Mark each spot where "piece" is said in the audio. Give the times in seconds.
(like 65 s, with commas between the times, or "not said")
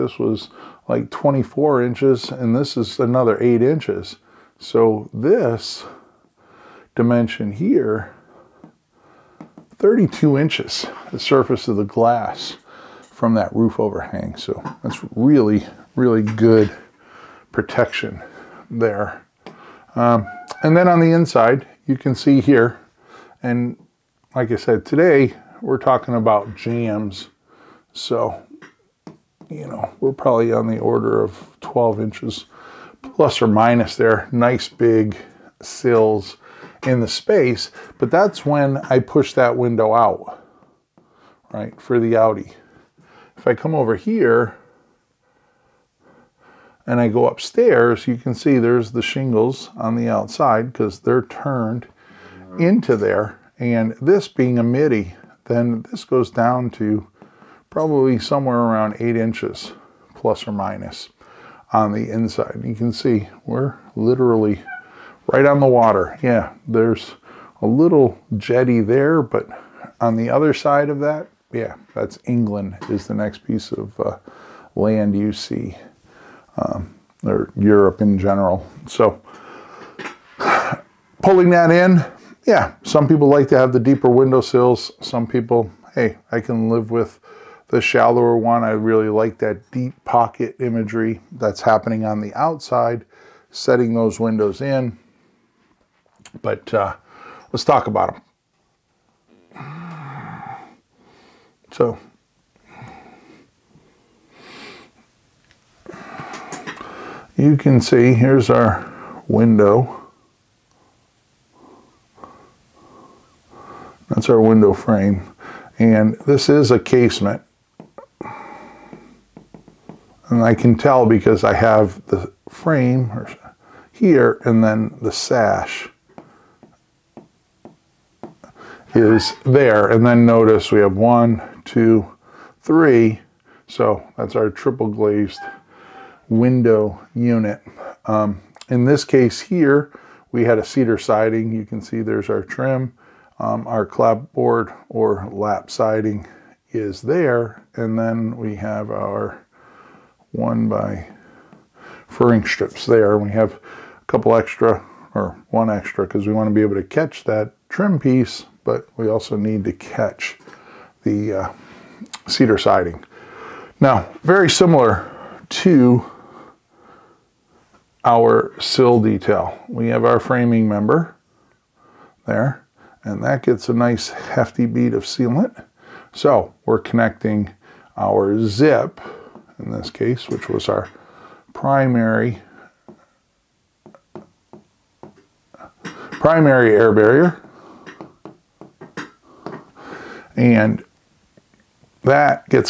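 73 s, 157 s.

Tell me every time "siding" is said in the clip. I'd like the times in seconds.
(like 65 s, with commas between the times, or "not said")
140 s, 145 s, 162 s.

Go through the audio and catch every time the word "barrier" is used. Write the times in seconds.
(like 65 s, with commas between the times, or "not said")
186 s.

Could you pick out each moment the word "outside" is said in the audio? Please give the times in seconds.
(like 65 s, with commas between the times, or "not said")
50 s, 92 s.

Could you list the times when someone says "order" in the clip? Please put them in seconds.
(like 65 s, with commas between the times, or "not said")
30 s.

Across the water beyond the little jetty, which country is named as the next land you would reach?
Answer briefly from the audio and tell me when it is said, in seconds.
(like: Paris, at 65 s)
England, at 72 s.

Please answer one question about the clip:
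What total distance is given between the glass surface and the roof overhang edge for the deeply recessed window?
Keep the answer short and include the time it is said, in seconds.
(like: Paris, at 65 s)
32 inches, at 9 s.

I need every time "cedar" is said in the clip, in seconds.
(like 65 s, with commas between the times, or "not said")
140 s, 162 s.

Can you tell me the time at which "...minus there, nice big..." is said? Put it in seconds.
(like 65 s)
33 s.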